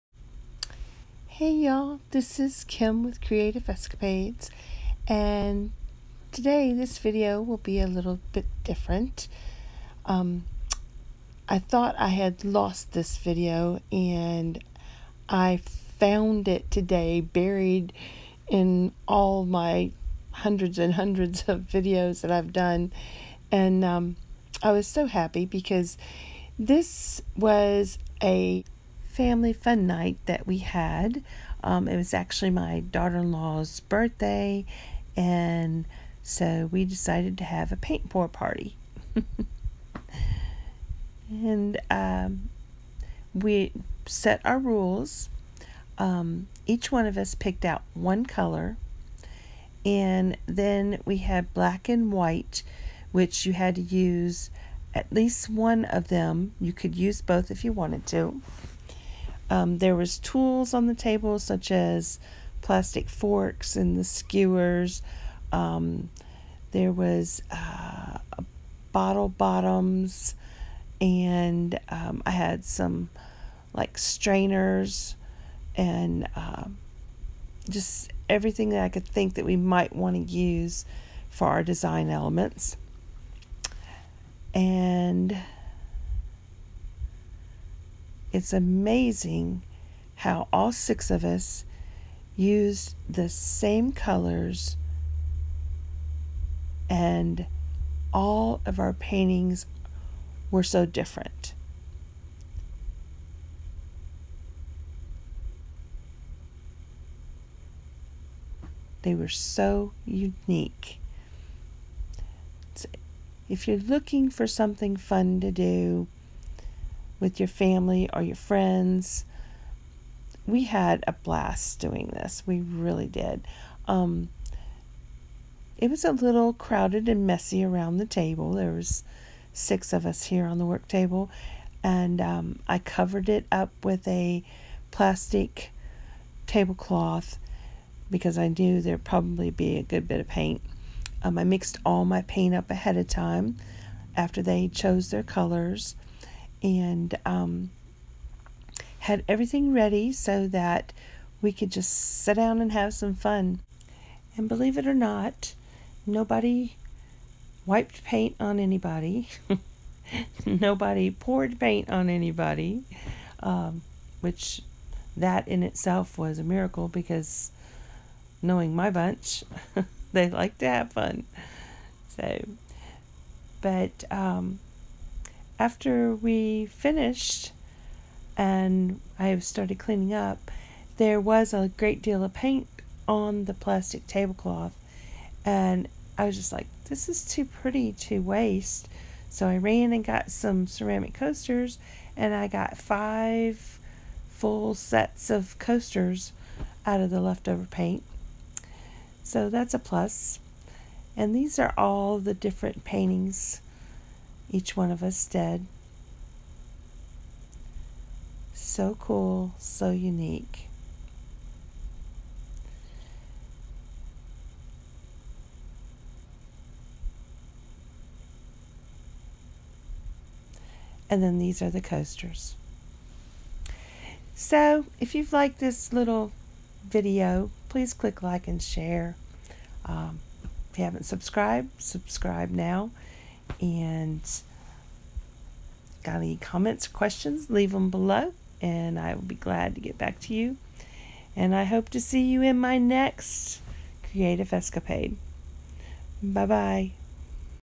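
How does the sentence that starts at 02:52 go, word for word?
So, but um, after we finished and I started cleaning up, there was a great deal of paint on the plastic tablecloth.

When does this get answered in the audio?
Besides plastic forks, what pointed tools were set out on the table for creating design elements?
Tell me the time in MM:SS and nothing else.
01:03.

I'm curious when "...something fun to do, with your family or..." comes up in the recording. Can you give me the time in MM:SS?
01:54.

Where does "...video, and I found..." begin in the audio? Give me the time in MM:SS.
00:13.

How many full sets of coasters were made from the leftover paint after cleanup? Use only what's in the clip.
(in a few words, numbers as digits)
5.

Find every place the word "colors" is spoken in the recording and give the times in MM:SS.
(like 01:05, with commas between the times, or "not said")
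00:48, 01:33, 02:25.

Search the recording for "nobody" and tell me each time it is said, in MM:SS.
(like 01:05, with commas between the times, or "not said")
02:36, 02:40.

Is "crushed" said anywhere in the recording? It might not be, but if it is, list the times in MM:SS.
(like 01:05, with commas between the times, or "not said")
not said.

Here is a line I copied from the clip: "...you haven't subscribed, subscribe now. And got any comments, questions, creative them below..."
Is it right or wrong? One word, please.
wrong.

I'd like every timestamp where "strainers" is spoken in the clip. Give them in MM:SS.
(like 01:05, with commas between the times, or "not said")
01:13.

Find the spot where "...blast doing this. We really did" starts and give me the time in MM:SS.
02:01.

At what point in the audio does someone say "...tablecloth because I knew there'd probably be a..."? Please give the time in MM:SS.
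02:16.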